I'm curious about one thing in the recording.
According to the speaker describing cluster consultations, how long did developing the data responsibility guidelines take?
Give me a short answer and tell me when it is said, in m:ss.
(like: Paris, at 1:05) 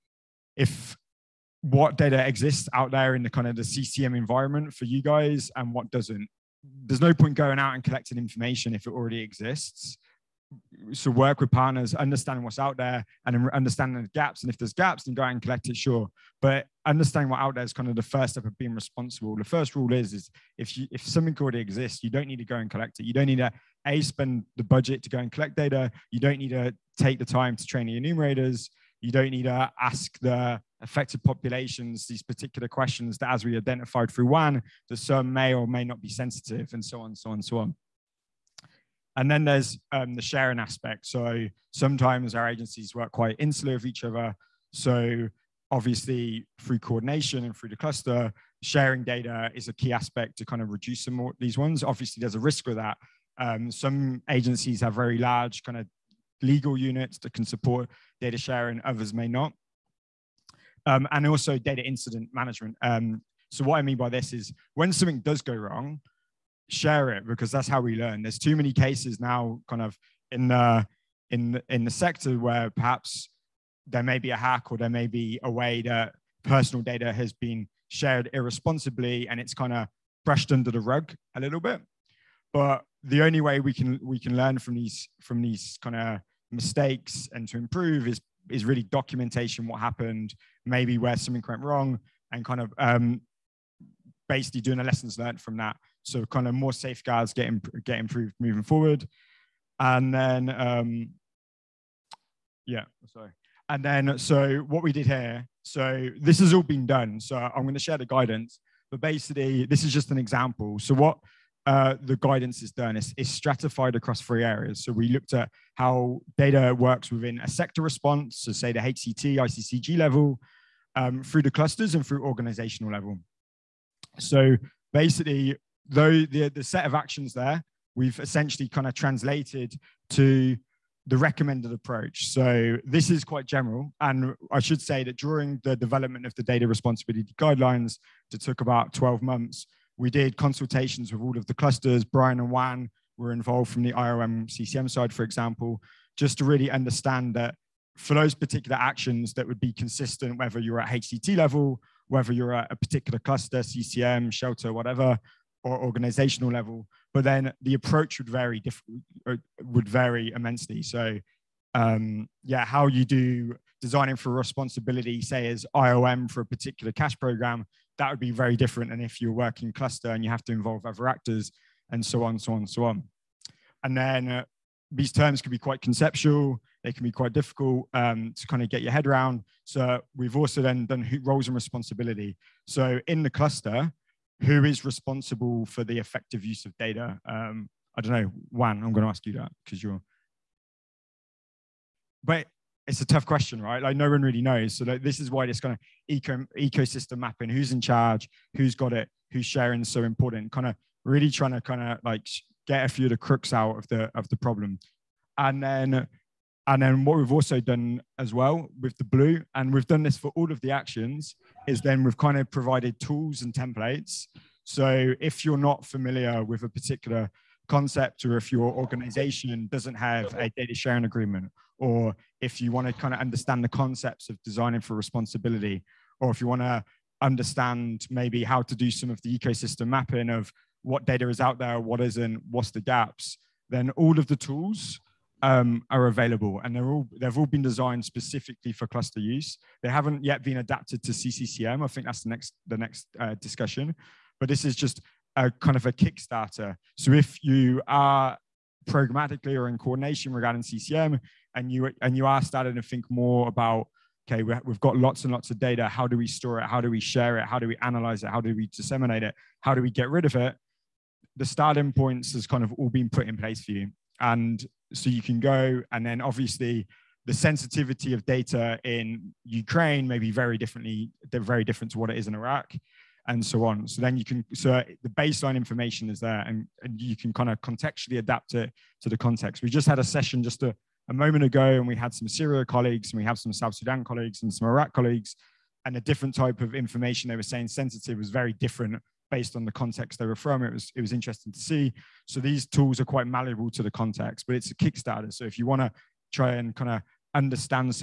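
12 months, at 2:18.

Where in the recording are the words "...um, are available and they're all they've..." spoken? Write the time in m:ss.
3:55.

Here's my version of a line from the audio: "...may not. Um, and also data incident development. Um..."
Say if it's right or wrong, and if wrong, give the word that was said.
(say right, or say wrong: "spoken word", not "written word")
wrong: "management", not "development".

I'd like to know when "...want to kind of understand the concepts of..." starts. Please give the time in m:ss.
3:42.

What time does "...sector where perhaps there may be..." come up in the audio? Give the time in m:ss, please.
1:11.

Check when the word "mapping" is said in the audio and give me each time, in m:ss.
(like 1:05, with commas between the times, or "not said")
3:17, 3:49.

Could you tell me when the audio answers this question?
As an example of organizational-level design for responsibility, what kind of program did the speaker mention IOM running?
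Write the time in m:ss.
2:46.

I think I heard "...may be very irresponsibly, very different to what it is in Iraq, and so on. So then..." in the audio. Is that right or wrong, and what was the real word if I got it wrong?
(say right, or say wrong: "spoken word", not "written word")
wrong: "differently", not "irresponsibly".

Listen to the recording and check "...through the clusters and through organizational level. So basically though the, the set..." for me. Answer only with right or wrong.
right.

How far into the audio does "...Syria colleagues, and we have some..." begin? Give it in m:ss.
4:42.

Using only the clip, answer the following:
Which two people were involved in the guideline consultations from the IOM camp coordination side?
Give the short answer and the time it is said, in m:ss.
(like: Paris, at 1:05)
Brian and Juan, at 2:22.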